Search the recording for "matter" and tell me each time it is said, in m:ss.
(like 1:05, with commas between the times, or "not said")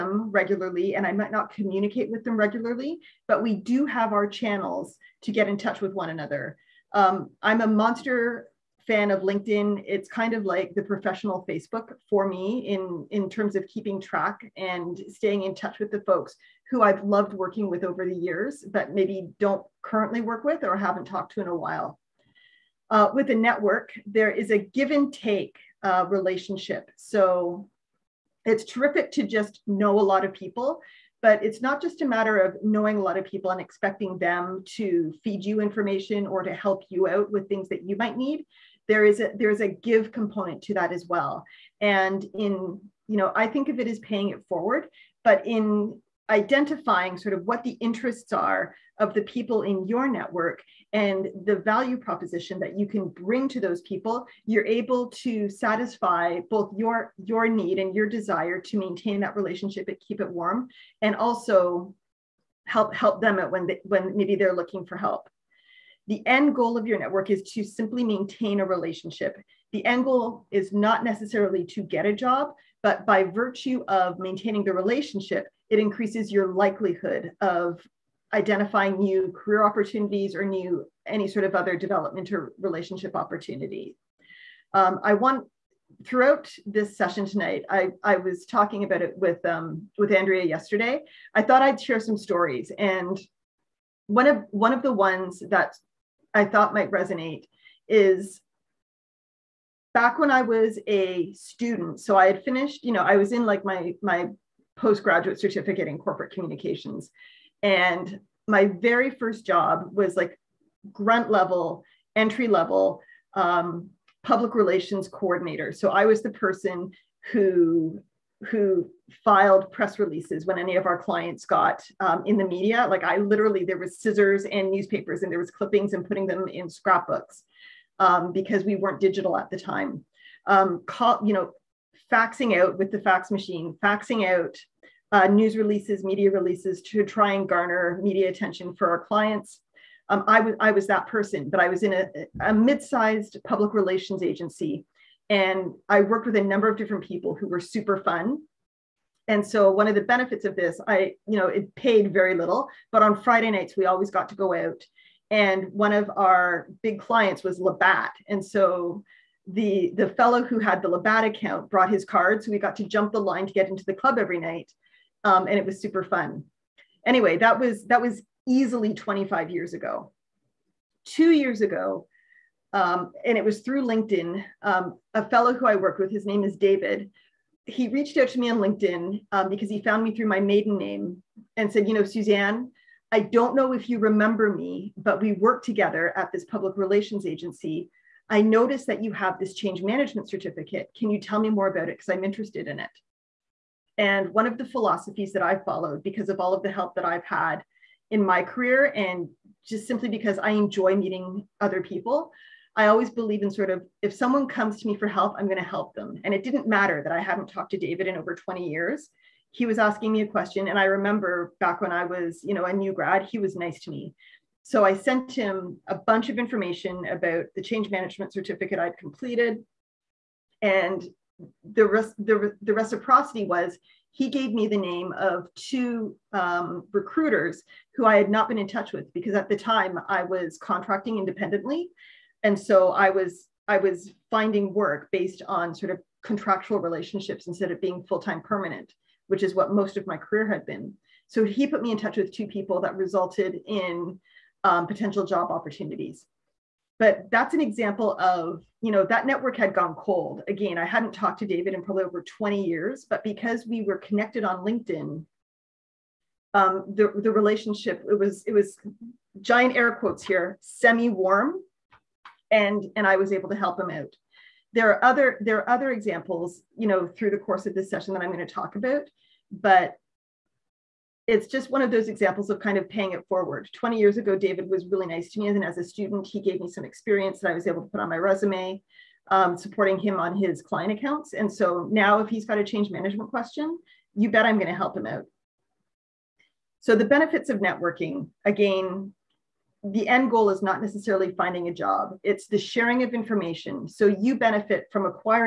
0:32, 3:26.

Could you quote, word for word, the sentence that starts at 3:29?
He was asking me a question.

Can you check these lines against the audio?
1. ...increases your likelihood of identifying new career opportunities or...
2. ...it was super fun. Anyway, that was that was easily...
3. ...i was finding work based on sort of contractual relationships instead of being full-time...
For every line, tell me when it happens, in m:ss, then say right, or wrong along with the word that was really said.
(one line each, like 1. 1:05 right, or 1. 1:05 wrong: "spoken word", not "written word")
1. 1:15 right
2. 2:45 right
3. 3:53 right.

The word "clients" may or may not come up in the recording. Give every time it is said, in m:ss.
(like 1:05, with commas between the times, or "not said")
2:00, 2:19, 2:36, 4:40.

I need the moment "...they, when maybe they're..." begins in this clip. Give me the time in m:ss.
1:03.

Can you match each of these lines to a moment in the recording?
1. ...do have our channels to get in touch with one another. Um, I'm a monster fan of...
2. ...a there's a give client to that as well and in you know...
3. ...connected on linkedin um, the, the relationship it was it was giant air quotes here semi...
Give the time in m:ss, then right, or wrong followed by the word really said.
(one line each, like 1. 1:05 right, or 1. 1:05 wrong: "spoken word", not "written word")
1. 0:03 right
2. 0:39 wrong: "component", not "client"
3. 4:13 right.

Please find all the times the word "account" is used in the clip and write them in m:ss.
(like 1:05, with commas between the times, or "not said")
2:41, 4:40.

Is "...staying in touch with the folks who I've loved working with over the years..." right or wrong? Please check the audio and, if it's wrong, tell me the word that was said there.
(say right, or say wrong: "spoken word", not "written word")
right.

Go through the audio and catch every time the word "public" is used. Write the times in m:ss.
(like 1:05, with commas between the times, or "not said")
1:54, 2:23, 3:06.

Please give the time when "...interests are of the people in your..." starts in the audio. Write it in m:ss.
0:47.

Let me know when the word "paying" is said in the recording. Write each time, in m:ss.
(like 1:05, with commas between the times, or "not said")
0:43, 4:32.